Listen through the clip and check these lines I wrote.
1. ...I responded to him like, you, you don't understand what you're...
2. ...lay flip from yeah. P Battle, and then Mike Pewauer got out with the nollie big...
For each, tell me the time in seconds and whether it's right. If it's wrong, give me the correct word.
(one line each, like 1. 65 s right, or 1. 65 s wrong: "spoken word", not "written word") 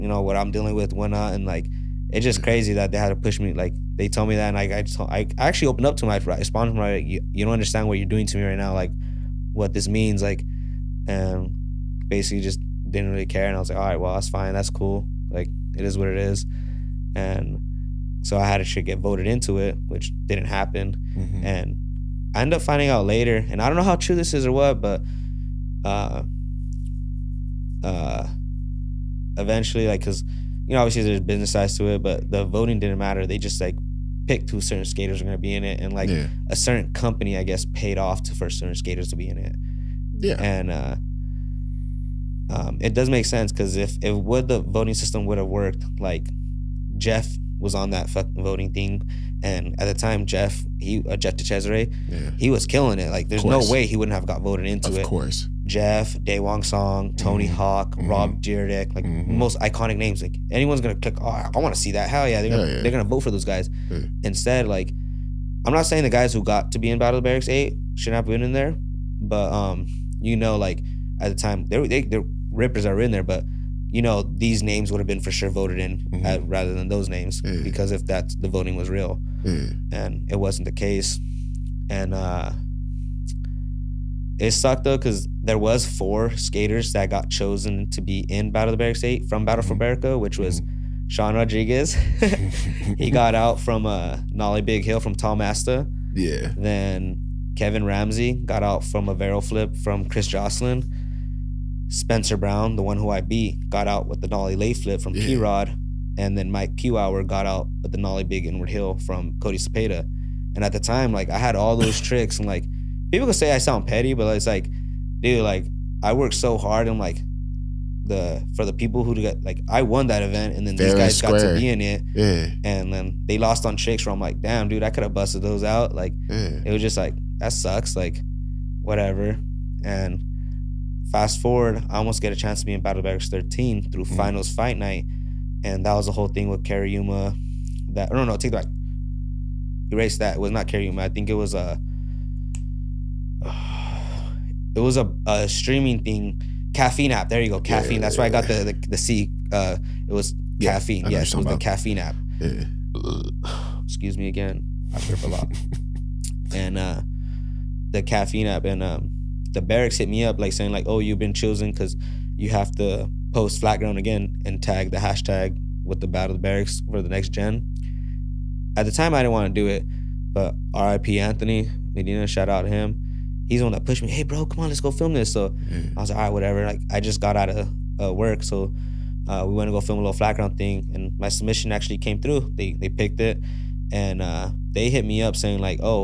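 1. 6 s right
2. 104 s wrong: "Rod", not "Battle".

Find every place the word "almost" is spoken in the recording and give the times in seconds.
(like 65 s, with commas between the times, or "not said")
131 s.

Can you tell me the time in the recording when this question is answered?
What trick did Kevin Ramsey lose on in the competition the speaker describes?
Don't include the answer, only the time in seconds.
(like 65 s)
99 s.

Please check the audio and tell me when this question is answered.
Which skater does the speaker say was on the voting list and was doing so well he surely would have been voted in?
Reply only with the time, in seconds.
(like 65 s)
51 s.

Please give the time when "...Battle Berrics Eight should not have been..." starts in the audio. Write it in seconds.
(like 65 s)
66 s.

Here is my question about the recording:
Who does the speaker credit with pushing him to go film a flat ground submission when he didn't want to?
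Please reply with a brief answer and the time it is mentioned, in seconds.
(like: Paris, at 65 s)
Anthony Medina, at 171 s.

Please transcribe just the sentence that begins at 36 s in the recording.
a certain company, I guess, paid off to for certain skaters to be in it.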